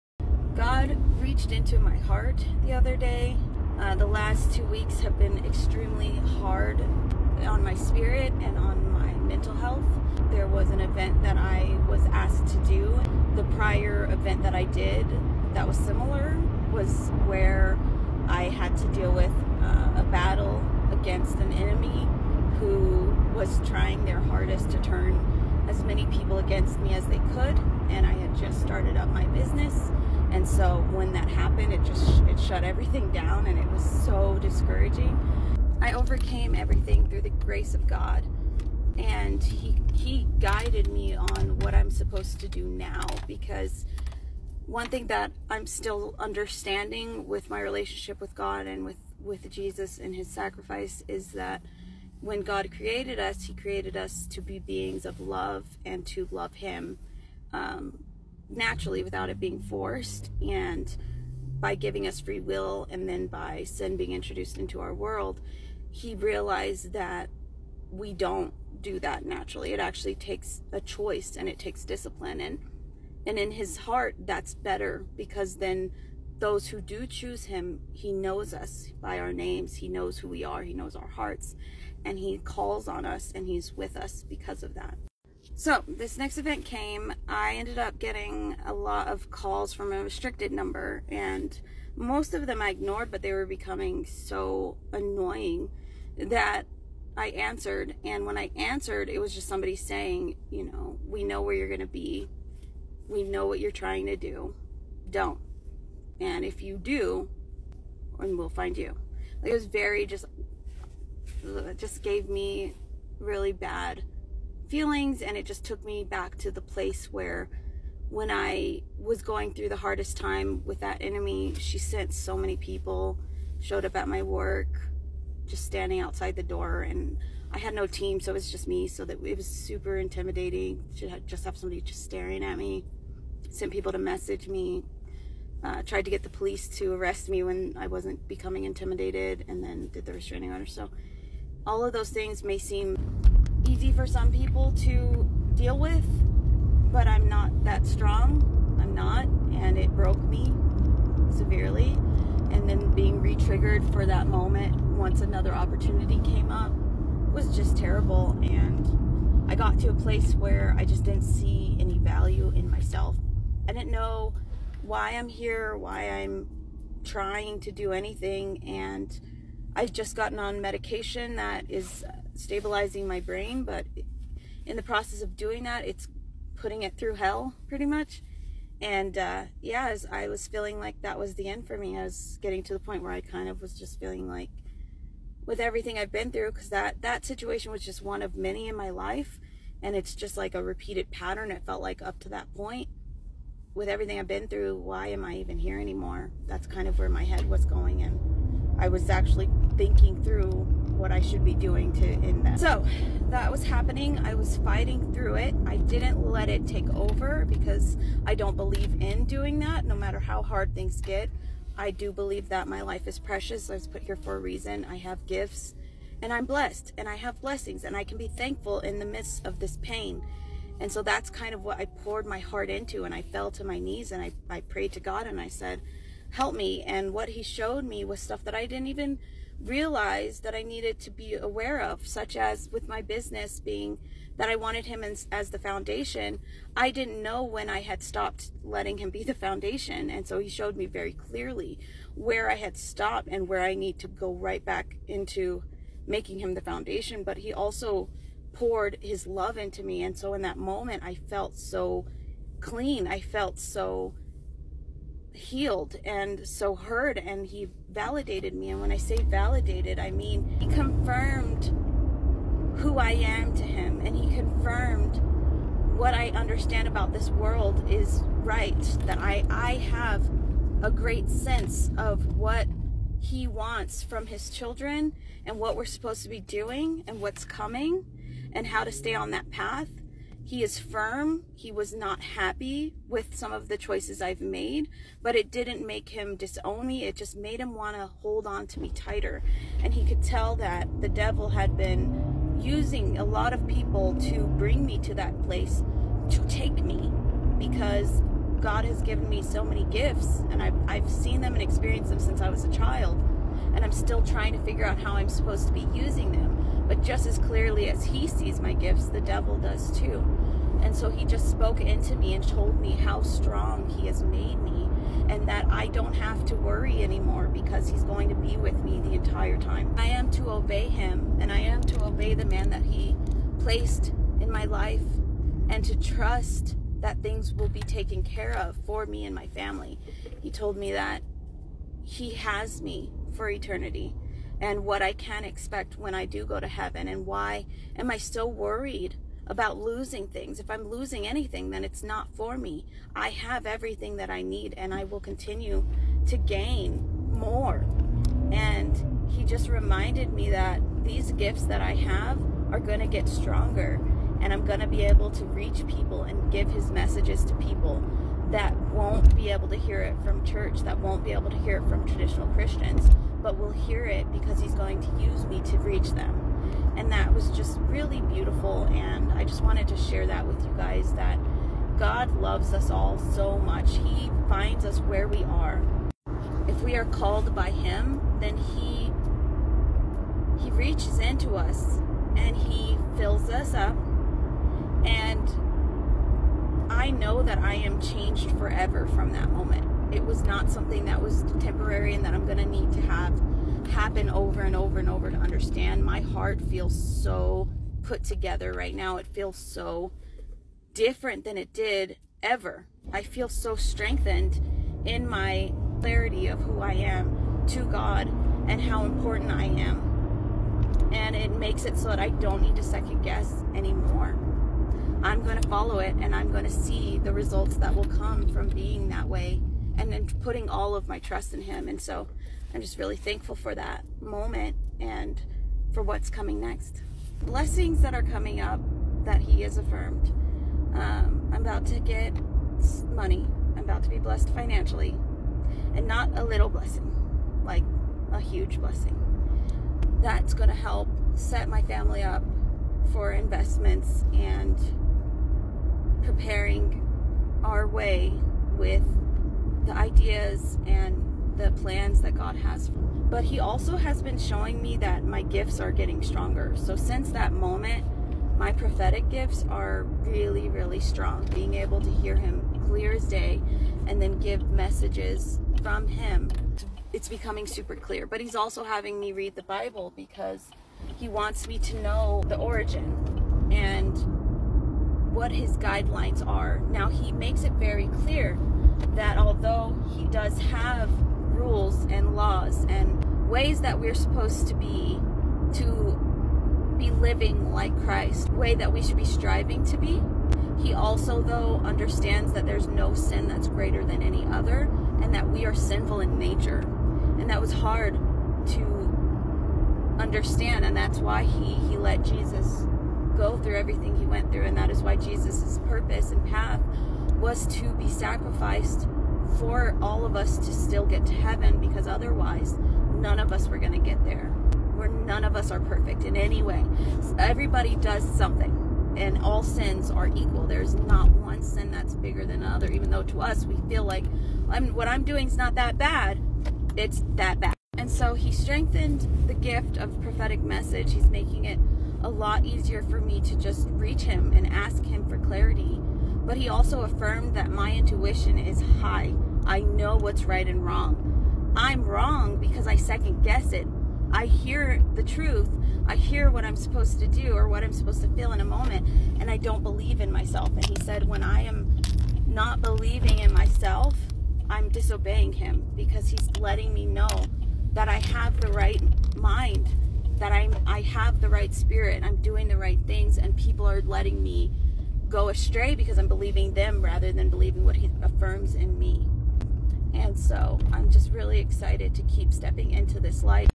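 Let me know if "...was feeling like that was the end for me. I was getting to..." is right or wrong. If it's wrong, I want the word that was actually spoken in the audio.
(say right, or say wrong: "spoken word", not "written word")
right.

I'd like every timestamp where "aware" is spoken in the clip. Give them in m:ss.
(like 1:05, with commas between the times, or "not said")
3:51.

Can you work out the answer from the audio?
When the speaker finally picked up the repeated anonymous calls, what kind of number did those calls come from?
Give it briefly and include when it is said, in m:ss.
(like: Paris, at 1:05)
restricted number, at 1:30.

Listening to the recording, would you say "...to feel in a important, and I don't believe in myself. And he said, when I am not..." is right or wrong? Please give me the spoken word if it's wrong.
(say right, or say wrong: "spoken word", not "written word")
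wrong: "moment", not "important".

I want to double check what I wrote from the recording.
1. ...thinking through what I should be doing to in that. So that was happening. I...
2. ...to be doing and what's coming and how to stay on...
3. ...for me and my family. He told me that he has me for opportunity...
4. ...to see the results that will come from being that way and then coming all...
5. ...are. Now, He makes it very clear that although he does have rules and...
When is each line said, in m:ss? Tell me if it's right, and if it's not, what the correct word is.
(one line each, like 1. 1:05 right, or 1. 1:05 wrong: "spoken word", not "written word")
1. 3:19 right
2. 4:36 right
3. 5:28 wrong: "eternity", not "opportunity"
4. 6:56 wrong: "putting", not "coming"
5. 7:56 right.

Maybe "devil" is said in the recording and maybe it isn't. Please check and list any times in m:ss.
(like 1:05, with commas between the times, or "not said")
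4:51, 5:09.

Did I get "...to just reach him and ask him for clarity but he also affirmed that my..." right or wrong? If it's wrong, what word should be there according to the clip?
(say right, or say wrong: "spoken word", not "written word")
right.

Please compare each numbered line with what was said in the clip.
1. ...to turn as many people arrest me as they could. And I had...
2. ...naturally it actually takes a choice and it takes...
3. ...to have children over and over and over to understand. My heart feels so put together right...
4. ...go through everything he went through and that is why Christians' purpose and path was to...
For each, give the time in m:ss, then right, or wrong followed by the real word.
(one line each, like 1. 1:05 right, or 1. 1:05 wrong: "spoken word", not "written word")
1. 0:24 wrong: "against", not "arrest"
2. 1:09 right
3. 6:32 wrong: "happen", not "children"
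4. 8:23 wrong: "Jesus", not "Christians".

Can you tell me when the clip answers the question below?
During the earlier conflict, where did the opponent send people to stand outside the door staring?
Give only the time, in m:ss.
2:04.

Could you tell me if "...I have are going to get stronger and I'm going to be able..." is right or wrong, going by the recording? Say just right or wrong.
right.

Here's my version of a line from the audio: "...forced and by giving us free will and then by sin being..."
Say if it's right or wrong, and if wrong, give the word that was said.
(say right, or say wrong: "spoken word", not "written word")
right.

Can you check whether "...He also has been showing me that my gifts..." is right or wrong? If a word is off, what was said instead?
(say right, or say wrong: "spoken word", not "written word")
right.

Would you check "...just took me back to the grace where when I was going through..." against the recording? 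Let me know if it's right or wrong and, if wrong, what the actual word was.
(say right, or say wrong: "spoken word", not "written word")
wrong: "place", not "grace".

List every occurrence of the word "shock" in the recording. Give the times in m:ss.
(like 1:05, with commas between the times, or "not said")
not said.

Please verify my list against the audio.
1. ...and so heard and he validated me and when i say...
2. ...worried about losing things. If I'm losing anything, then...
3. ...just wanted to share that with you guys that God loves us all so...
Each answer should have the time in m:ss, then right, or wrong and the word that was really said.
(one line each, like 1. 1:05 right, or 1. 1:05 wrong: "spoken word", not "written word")
1. 4:16 right
2. 5:38 right
3. 6:09 right.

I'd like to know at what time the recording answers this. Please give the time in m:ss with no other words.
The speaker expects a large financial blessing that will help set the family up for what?
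7:23.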